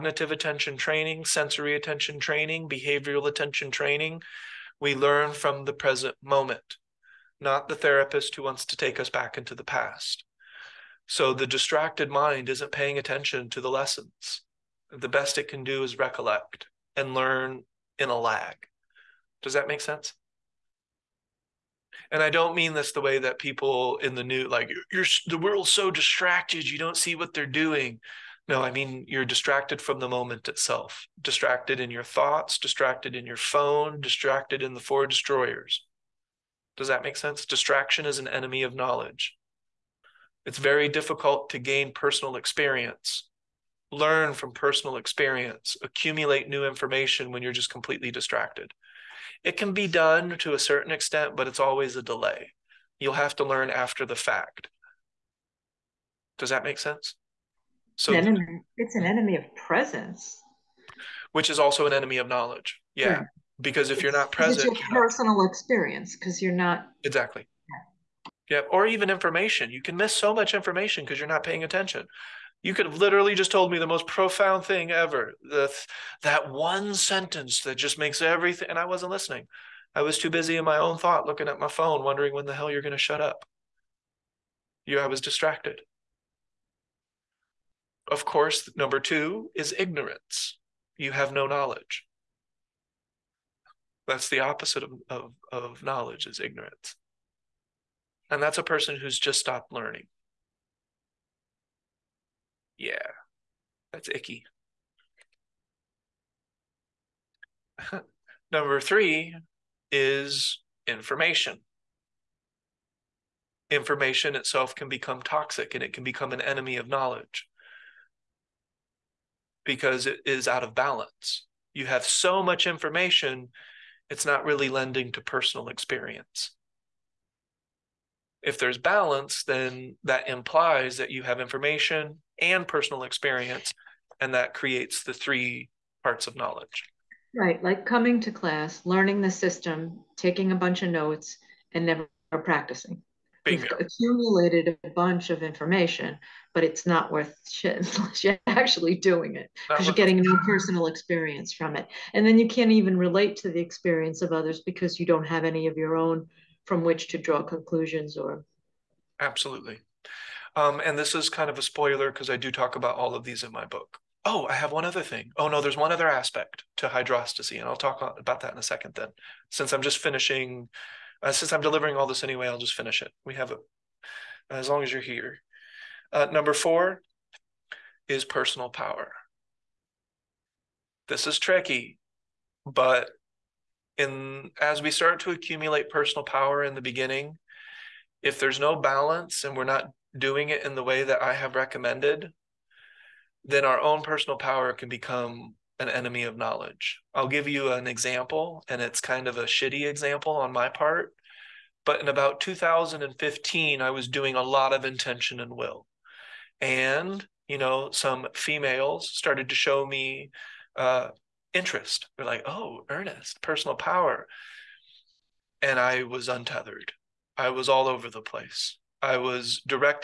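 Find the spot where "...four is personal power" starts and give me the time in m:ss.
2:56.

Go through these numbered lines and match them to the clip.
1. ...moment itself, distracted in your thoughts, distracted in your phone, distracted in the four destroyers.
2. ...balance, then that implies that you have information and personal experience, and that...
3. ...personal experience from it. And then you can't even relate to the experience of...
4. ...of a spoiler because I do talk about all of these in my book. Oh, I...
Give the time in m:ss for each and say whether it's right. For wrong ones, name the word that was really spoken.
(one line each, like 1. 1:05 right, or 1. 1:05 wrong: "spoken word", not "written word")
1. 0:30 right
2. 2:08 right
3. 2:30 right
4. 2:41 right.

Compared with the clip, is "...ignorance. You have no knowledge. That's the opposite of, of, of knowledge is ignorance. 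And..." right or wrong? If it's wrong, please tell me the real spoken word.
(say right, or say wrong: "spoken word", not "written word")
right.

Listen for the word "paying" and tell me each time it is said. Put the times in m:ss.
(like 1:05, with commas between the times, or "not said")
0:12, 1:11.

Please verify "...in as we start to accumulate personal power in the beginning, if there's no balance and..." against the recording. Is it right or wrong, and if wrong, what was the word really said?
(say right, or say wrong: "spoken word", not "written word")
right.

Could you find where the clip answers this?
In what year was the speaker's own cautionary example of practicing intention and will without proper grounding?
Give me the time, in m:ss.
3:22.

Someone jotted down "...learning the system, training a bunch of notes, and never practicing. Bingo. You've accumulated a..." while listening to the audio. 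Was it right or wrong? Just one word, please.
wrong.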